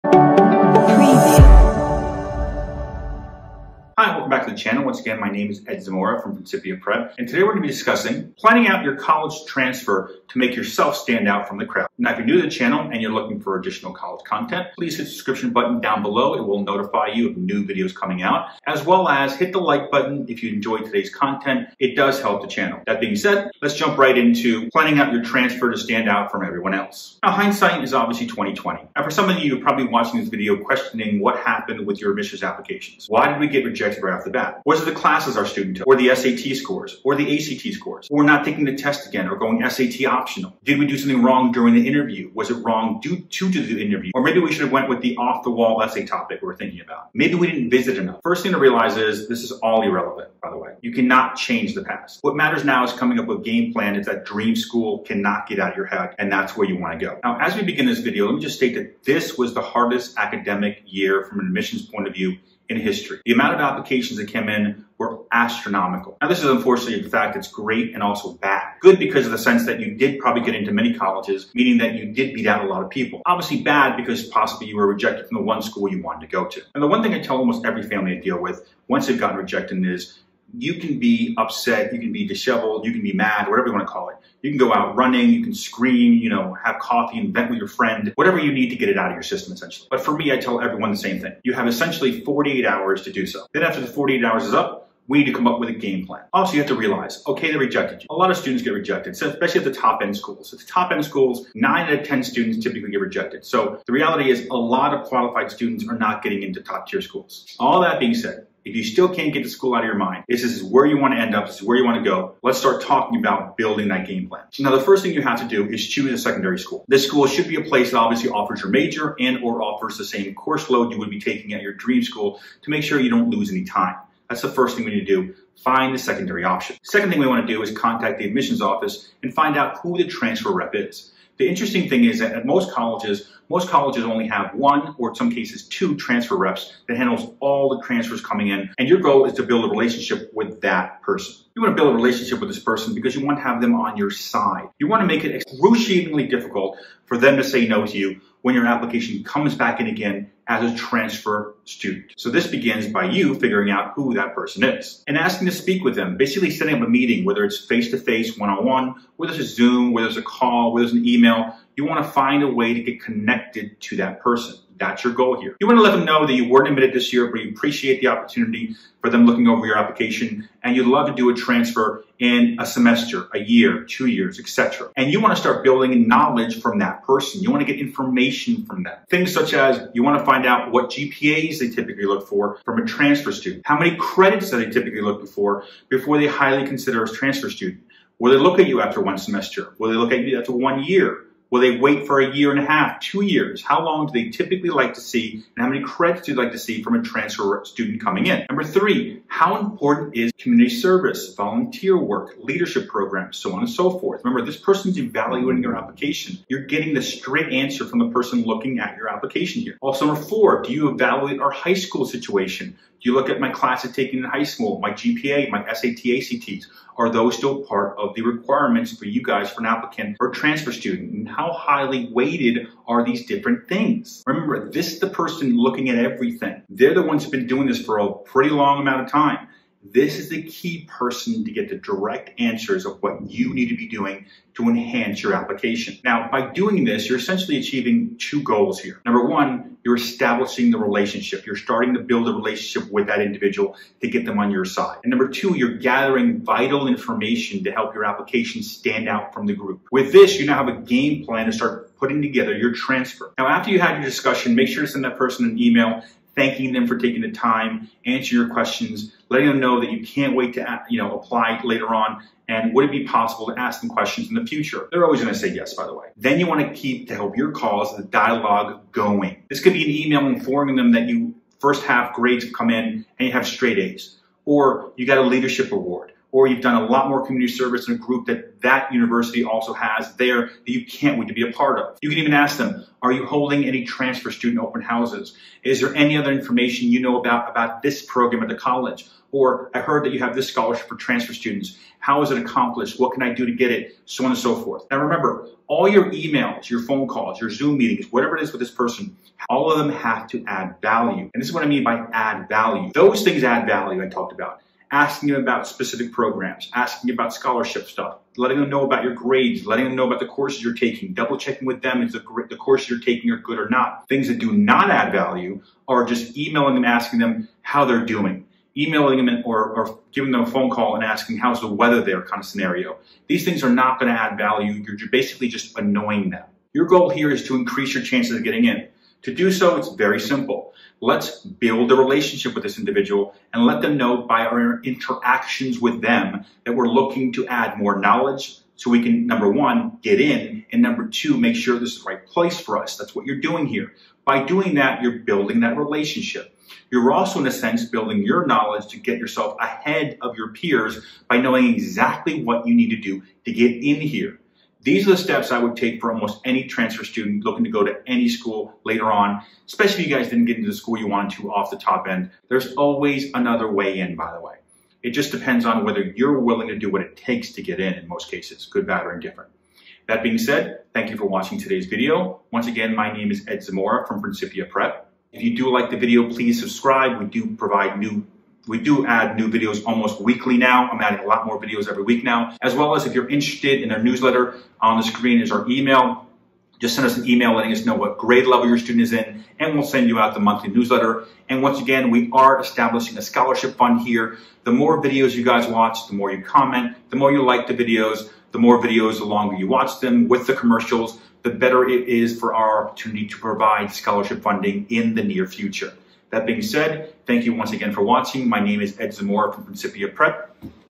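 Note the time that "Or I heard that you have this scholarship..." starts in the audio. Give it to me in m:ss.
4:49.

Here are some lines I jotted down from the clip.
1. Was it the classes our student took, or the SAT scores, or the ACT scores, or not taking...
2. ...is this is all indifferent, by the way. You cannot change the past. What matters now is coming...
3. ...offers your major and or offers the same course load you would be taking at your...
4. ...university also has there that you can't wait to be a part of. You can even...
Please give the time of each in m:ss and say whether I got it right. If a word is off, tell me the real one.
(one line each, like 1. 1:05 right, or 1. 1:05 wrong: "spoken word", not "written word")
1. 0:34 right
2. 0:48 wrong: "irrelevant", not "indifferent"
3. 1:58 right
4. 4:38 right.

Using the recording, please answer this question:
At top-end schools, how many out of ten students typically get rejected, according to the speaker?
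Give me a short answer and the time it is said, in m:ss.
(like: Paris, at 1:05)
9, at 1:41.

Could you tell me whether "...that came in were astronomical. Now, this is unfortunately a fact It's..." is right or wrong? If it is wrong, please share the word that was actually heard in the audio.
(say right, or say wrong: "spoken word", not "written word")
right.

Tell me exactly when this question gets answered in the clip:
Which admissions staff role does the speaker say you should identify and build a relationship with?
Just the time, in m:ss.
2:10.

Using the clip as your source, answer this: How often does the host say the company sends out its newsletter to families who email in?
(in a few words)
monthly.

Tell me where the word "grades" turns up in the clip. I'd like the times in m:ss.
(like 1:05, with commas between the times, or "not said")
4:32, 5:09, 6:28.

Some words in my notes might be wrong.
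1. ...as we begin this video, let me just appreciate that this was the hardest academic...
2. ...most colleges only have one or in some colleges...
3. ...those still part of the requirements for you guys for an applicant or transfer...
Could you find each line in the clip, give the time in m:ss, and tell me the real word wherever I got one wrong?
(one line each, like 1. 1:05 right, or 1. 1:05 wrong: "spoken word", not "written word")
1. 0:57 wrong: "state", not "appreciate"
2. 2:13 wrong: "cases", not "colleges"
3. 3:37 right.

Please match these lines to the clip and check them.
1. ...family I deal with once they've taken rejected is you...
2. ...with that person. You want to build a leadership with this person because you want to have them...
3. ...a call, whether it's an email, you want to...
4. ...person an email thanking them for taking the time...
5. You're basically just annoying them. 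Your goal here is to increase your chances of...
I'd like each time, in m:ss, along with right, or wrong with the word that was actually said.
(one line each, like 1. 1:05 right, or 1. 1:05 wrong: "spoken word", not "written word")
1. 1:17 wrong: "gotten", not "taken"
2. 2:20 wrong: "relationship", not "leadership"
3. 2:40 right
4. 4:15 right
5. 5:24 right.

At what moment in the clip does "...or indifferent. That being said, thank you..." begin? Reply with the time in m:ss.
6:09.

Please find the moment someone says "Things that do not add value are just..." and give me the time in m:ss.
5:14.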